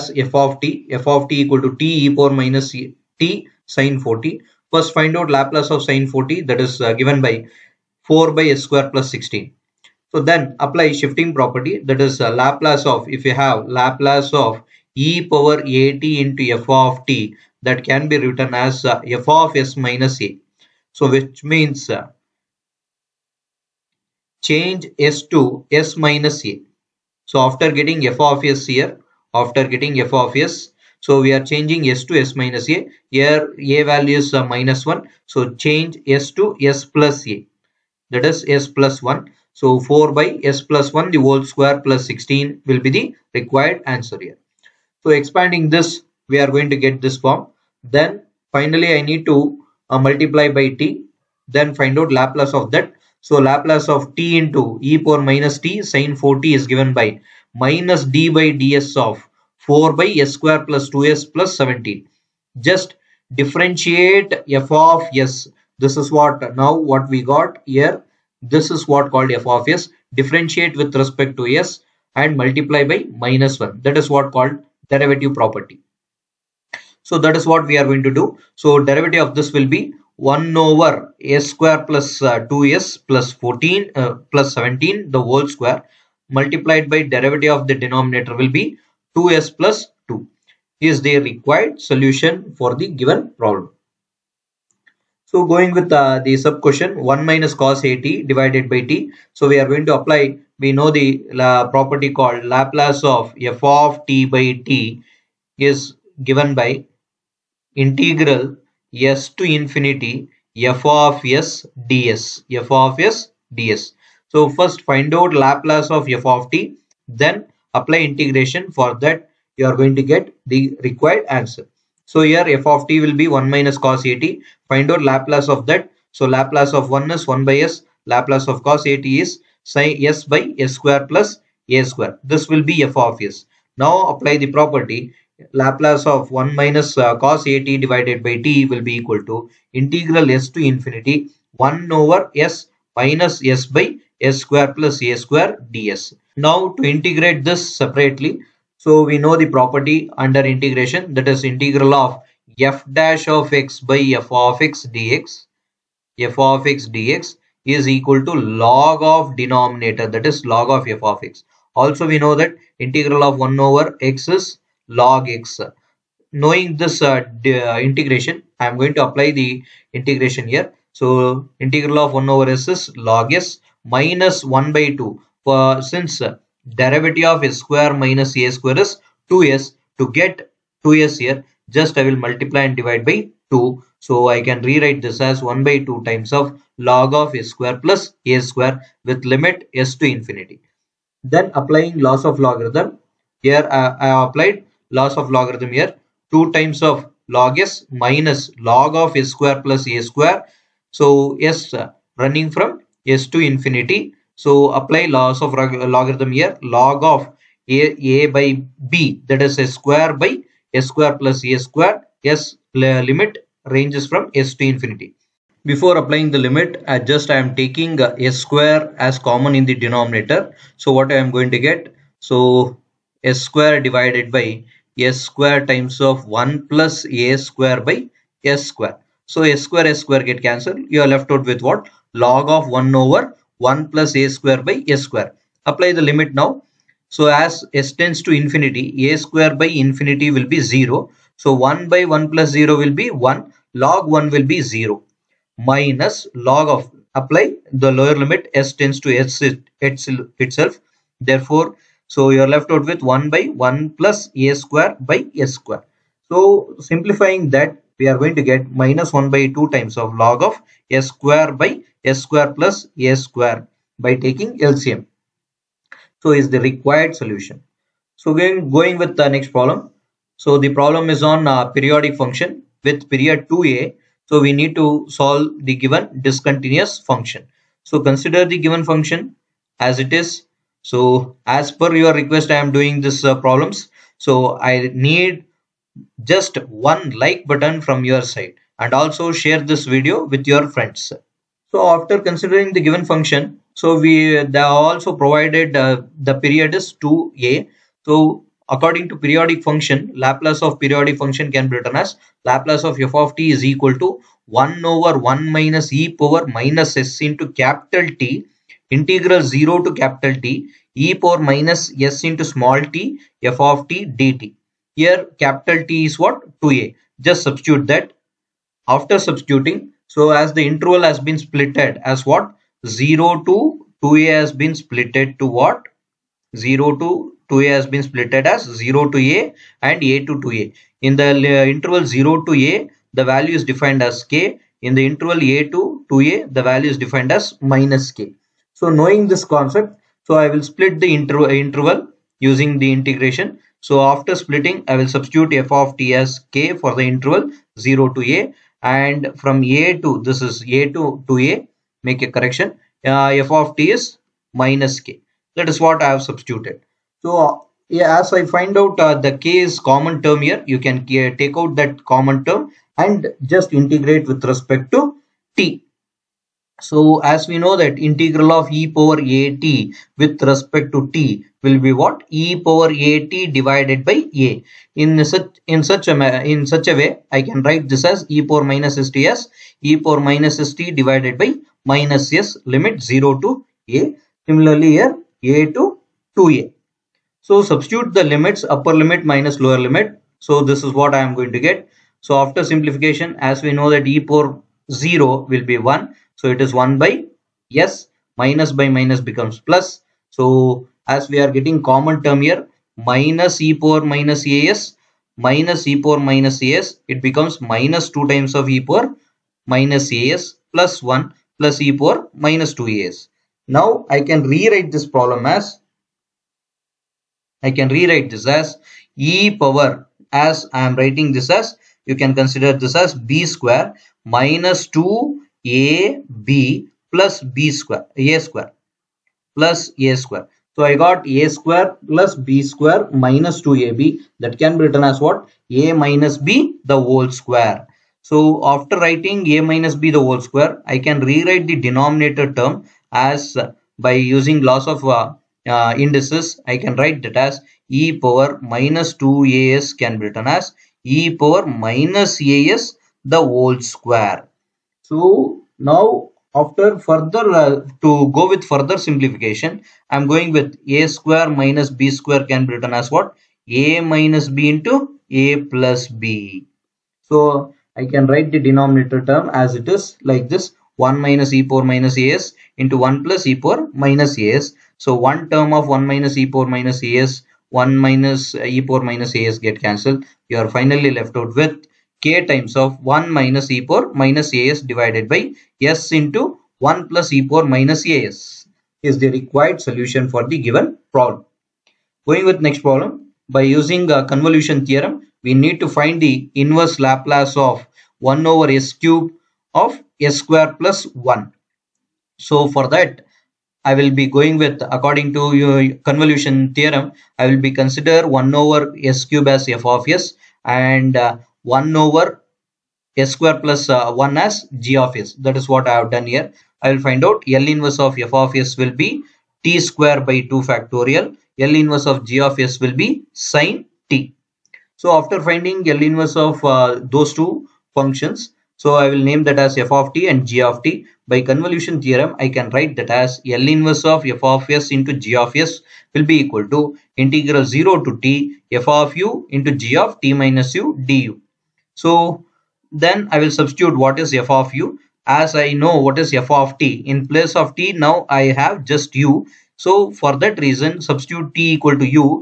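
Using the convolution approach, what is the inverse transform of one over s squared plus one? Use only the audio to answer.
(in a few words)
sine t.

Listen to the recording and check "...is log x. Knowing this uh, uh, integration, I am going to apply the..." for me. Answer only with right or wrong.
right.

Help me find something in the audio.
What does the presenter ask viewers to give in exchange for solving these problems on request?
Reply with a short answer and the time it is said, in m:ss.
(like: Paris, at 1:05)
one like, at 4:46.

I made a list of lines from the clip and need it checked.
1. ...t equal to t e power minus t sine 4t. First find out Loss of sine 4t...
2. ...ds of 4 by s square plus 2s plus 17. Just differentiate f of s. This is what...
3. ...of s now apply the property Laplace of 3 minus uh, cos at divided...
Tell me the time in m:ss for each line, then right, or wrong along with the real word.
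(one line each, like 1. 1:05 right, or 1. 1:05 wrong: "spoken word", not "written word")
1. 0:01 wrong: "Laplace", not "Loss"
2. 0:58 right
3. 2:13 wrong: "1", not "3".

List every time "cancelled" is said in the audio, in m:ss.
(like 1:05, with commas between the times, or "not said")
3:50, 7:59.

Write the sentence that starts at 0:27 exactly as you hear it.
So after getting f of s here, after getting f of s, so we are changing s to s minus a.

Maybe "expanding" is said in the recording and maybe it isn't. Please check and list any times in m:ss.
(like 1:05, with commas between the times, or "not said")
0:45.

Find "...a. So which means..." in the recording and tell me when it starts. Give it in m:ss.
0:20.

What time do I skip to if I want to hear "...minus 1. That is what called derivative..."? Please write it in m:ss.
1:13.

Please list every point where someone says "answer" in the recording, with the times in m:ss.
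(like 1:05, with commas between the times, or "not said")
0:43, 2:01.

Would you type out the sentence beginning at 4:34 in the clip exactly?
So we need to solve the given discontinuous function.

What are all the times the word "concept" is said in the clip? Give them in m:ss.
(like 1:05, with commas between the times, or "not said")
5:39.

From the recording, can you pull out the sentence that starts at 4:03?
Log 1 will be 0 minus log of apply the lower limit s tends to s itself.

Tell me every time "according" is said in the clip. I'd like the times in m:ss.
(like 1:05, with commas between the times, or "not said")
4:58, 8:24.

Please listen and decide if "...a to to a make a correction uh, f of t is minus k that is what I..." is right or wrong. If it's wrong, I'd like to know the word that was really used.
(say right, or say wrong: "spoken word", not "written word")
right.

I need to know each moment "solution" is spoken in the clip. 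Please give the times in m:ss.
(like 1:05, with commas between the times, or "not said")
1:31, 4:27, 8:09.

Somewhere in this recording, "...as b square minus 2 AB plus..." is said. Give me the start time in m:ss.
7:02.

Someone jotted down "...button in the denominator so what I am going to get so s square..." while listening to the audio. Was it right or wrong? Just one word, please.
wrong.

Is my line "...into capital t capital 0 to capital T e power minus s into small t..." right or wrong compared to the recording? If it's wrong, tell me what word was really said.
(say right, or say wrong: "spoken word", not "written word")
wrong: "integral", not "capital".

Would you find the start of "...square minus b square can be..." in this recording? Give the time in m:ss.
7:41.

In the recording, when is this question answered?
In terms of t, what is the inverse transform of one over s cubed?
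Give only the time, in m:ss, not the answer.
8:39.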